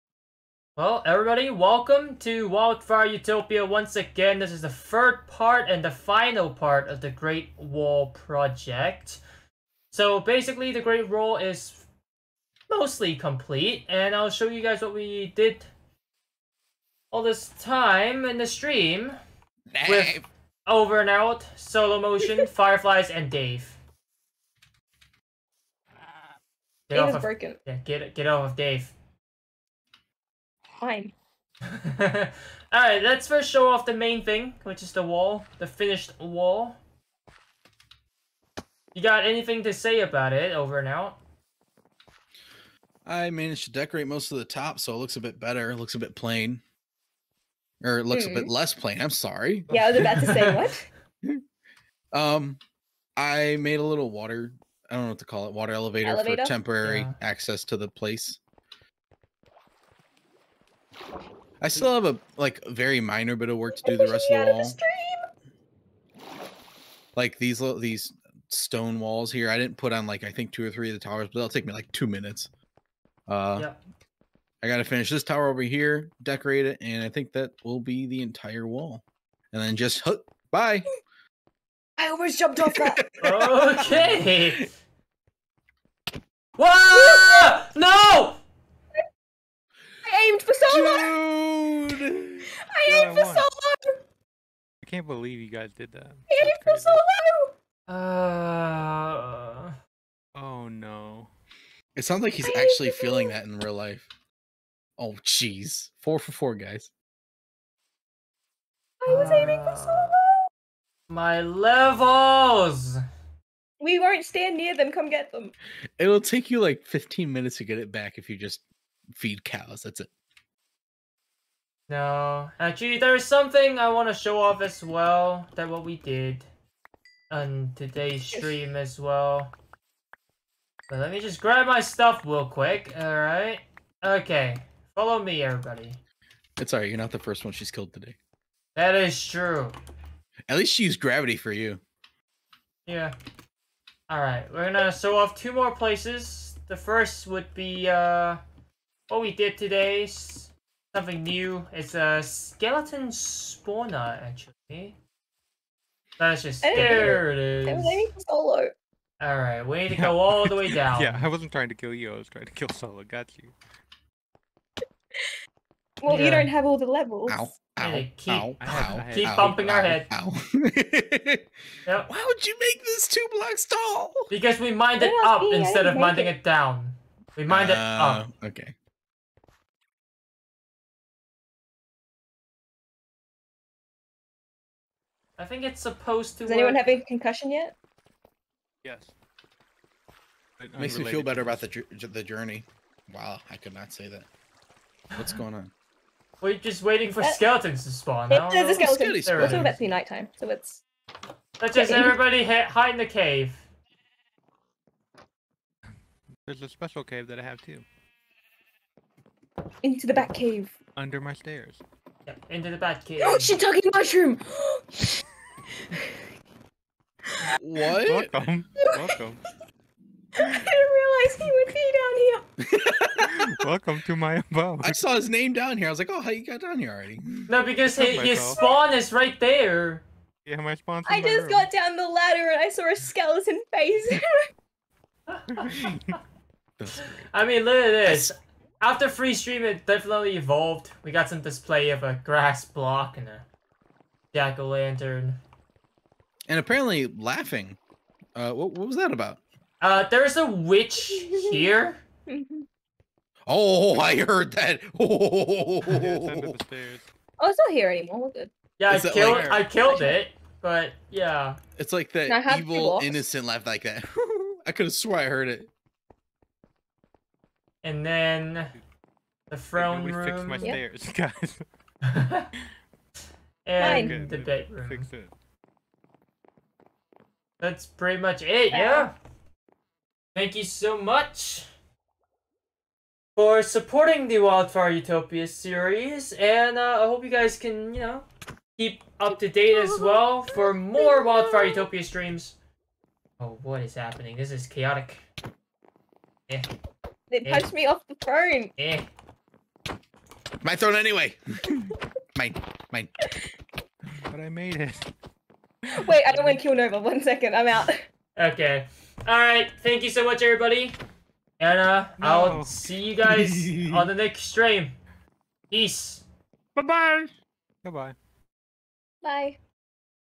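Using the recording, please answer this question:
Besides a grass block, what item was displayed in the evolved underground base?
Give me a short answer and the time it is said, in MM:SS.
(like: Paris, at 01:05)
Jack-o'-lantern, at 04:04.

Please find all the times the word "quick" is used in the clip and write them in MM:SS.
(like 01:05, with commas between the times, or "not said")
02:12.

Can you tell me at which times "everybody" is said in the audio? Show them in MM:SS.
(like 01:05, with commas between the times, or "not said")
00:01, 02:15, 03:21, 05:10.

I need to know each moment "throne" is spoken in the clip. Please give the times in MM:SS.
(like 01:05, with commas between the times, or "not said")
04:29, 05:00.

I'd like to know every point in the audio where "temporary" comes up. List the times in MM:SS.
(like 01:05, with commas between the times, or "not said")
00:56.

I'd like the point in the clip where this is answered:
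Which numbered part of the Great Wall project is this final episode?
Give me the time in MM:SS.
00:04.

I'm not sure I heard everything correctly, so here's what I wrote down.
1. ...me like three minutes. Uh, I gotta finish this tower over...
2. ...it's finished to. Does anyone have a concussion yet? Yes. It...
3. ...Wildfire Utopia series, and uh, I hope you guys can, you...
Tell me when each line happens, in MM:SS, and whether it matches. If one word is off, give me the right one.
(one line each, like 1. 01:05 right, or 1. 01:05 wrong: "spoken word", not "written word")
1. 01:11 wrong: "two", not "three"
2. 03:05 wrong: "supposed", not "finished"
3. 04:44 right.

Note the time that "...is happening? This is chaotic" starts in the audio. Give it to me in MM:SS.
04:53.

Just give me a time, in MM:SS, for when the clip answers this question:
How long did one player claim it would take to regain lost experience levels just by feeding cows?
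01:56.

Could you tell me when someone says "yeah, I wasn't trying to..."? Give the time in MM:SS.
02:41.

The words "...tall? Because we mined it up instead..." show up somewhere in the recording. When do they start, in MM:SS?
02:53.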